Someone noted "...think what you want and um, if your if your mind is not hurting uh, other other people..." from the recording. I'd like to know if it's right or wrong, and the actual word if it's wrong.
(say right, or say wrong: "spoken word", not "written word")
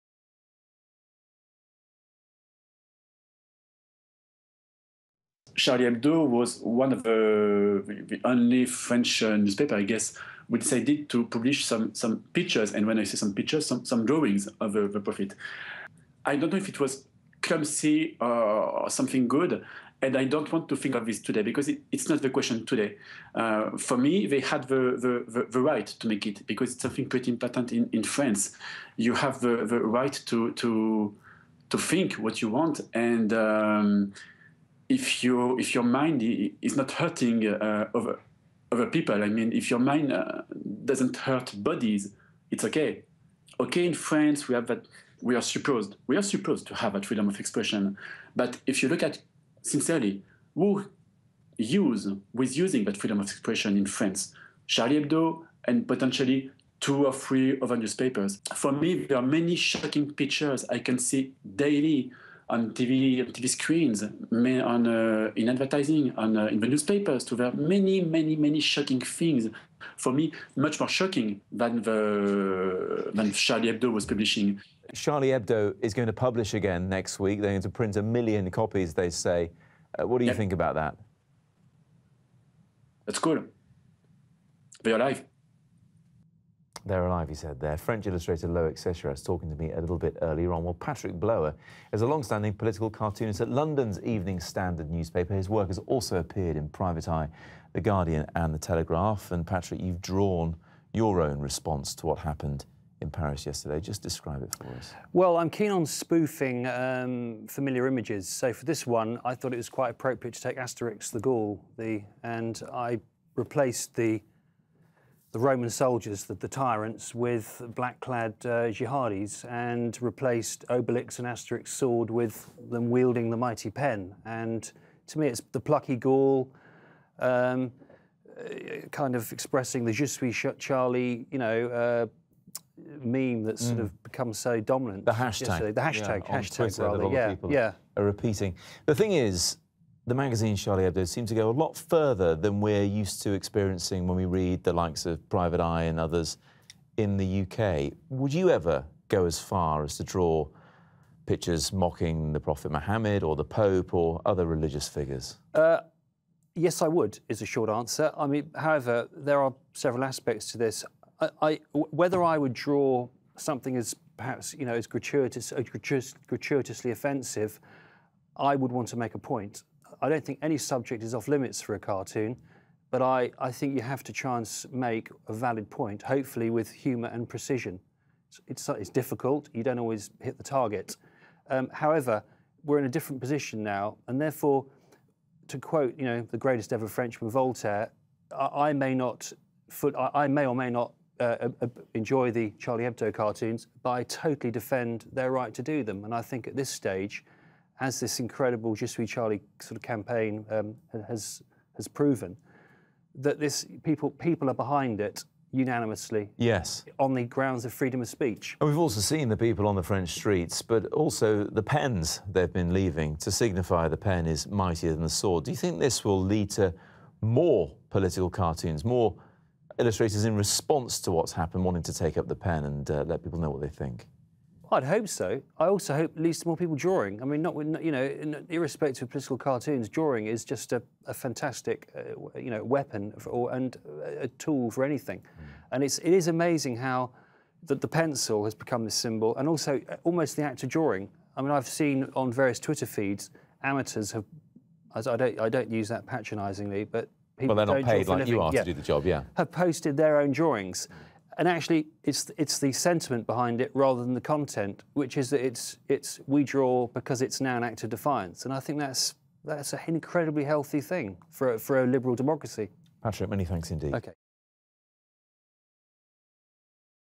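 right.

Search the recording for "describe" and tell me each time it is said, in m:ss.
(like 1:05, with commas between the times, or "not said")
1:44.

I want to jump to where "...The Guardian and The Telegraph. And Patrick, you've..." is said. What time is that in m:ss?
1:37.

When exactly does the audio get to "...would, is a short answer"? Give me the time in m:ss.
2:36.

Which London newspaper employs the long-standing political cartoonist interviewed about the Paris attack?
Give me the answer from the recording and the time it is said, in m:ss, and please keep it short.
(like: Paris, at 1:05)
Evening Standard, at 1:34.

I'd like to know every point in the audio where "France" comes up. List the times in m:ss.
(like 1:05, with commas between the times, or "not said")
0:28, 0:43, 0:53.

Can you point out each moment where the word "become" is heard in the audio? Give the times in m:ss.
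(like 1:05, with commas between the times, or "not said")
2:14, 3:58.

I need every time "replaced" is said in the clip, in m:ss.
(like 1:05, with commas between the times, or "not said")
1:53, 2:00.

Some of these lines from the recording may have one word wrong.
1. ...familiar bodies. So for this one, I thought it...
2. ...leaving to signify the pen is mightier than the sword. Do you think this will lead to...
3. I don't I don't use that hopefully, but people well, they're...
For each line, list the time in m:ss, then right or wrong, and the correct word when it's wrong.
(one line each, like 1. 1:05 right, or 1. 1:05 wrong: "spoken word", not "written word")
1. 1:47 wrong: "images", not "bodies"
2. 3:32 right
3. 4:04 wrong: "patronisingly", not "hopefully".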